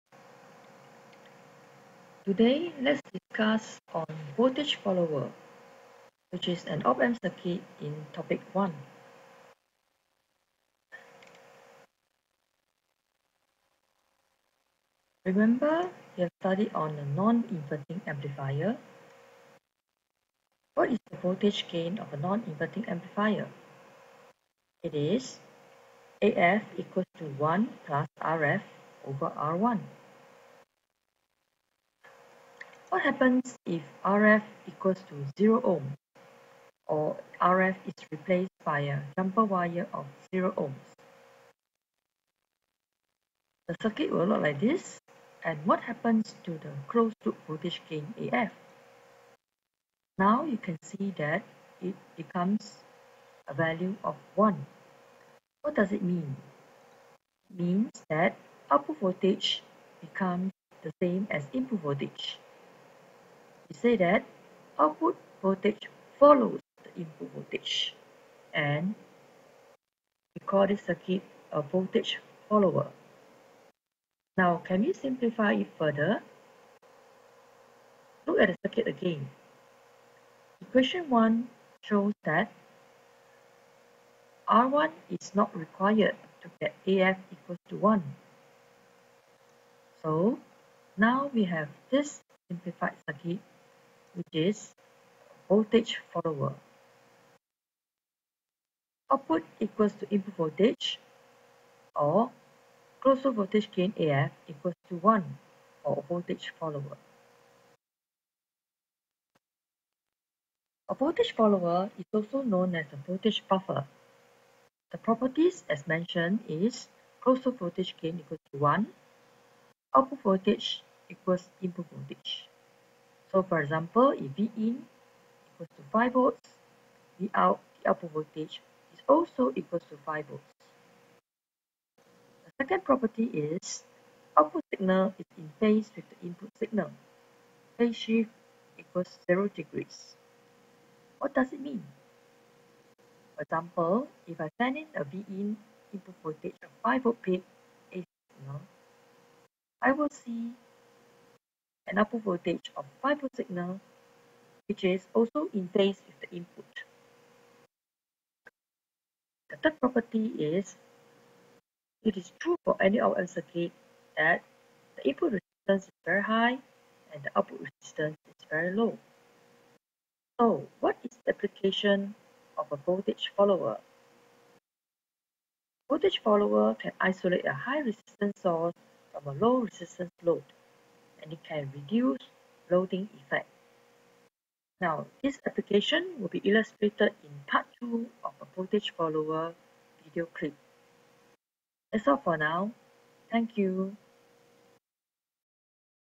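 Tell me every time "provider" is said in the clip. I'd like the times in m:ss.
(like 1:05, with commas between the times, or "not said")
not said.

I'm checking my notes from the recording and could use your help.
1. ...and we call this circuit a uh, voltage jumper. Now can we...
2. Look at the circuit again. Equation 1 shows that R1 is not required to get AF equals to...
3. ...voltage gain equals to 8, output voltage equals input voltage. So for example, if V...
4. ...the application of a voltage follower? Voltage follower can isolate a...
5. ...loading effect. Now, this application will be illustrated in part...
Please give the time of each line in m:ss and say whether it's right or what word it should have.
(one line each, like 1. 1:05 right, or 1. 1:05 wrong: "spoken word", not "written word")
1. 1:08 wrong: "follower", not "jumper"
2. 1:18 right
3. 1:57 wrong: "1", not "8"
4. 2:51 right
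5. 3:02 right.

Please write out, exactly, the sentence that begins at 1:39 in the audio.
Output equals to input voltage or closed voltage gain AF equals to 1 for voltage follower.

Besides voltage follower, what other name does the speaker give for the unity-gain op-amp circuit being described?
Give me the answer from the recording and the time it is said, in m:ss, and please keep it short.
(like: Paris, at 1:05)
Voltage buffer, at 1:53.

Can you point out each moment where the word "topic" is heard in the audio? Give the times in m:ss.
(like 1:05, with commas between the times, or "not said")
0:08.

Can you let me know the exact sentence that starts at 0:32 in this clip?
What happens if RF equals to 0 ohm or RF is replaced by a jumper wire of 0 ohms?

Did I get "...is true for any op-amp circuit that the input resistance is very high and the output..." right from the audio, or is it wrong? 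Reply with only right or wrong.
right.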